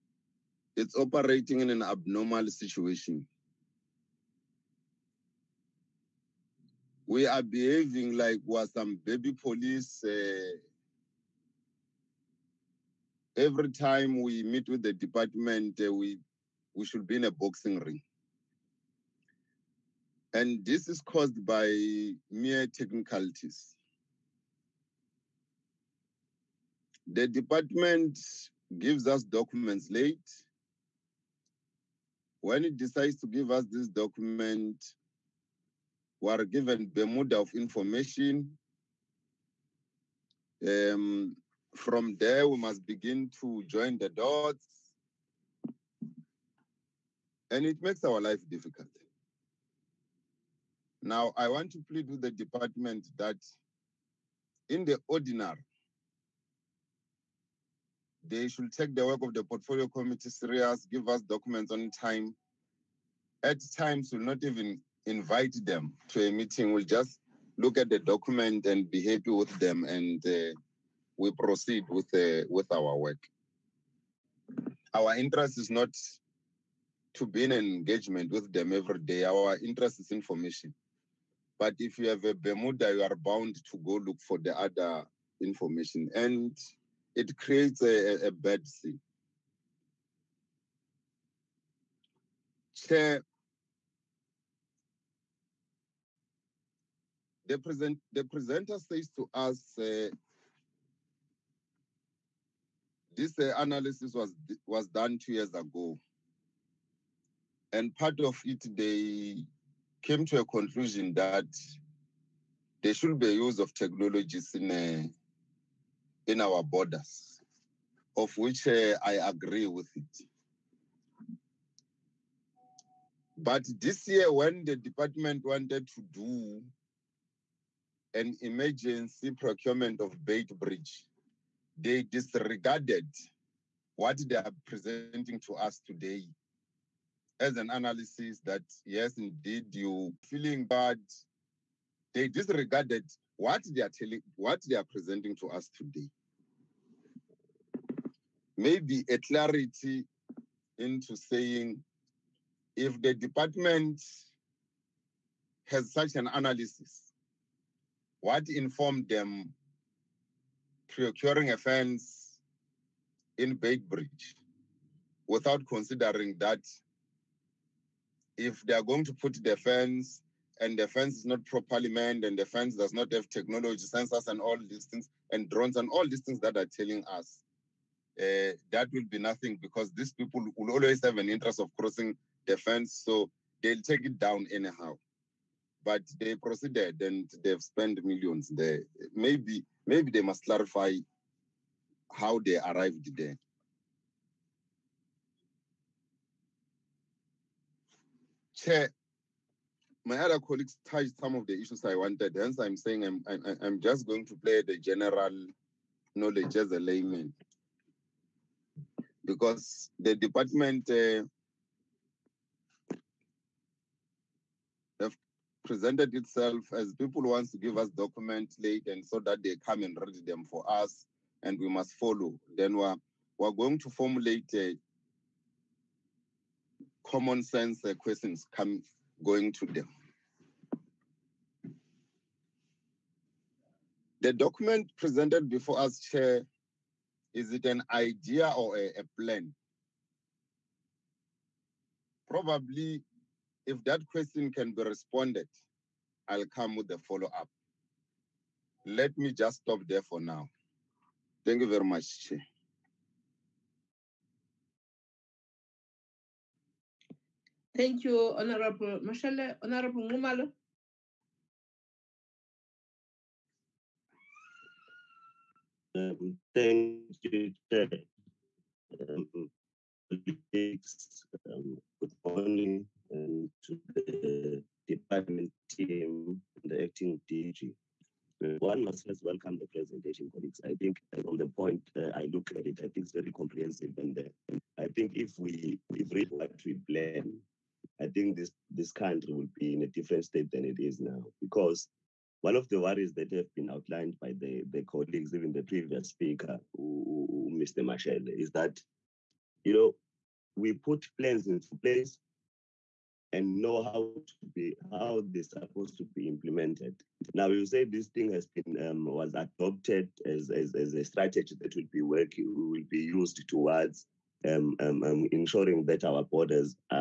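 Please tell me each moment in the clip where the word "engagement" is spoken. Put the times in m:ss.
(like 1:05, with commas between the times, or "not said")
1:17.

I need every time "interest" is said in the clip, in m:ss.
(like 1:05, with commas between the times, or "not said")
1:15, 1:19, 3:01.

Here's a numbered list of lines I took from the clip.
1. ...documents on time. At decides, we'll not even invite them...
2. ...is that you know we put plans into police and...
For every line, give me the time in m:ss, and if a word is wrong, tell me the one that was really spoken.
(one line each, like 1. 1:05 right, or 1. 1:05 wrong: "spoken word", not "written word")
1. 1:01 wrong: "times", not "decides"
2. 4:58 wrong: "place", not "police".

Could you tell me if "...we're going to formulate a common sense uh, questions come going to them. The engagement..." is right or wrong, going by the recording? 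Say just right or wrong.
wrong.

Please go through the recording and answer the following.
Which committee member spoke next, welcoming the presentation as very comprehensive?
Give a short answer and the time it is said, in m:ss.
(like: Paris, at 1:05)
Nxumalo, at 4:19.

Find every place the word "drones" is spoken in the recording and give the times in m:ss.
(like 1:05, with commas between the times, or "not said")
2:55.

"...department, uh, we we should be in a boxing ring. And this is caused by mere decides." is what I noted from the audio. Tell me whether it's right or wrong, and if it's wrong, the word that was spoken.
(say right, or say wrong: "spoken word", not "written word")
wrong: "technicalities", not "decides".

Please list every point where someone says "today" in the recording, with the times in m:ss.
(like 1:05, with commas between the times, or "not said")
2:15, 2:25.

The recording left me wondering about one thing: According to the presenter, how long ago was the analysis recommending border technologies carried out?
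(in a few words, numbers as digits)
2 years ago.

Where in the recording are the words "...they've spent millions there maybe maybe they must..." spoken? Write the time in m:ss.
3:07.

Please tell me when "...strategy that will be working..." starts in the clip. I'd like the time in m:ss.
5:11.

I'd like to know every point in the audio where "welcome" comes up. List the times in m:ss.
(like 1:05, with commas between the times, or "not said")
4:39.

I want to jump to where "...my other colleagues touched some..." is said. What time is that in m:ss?
3:20.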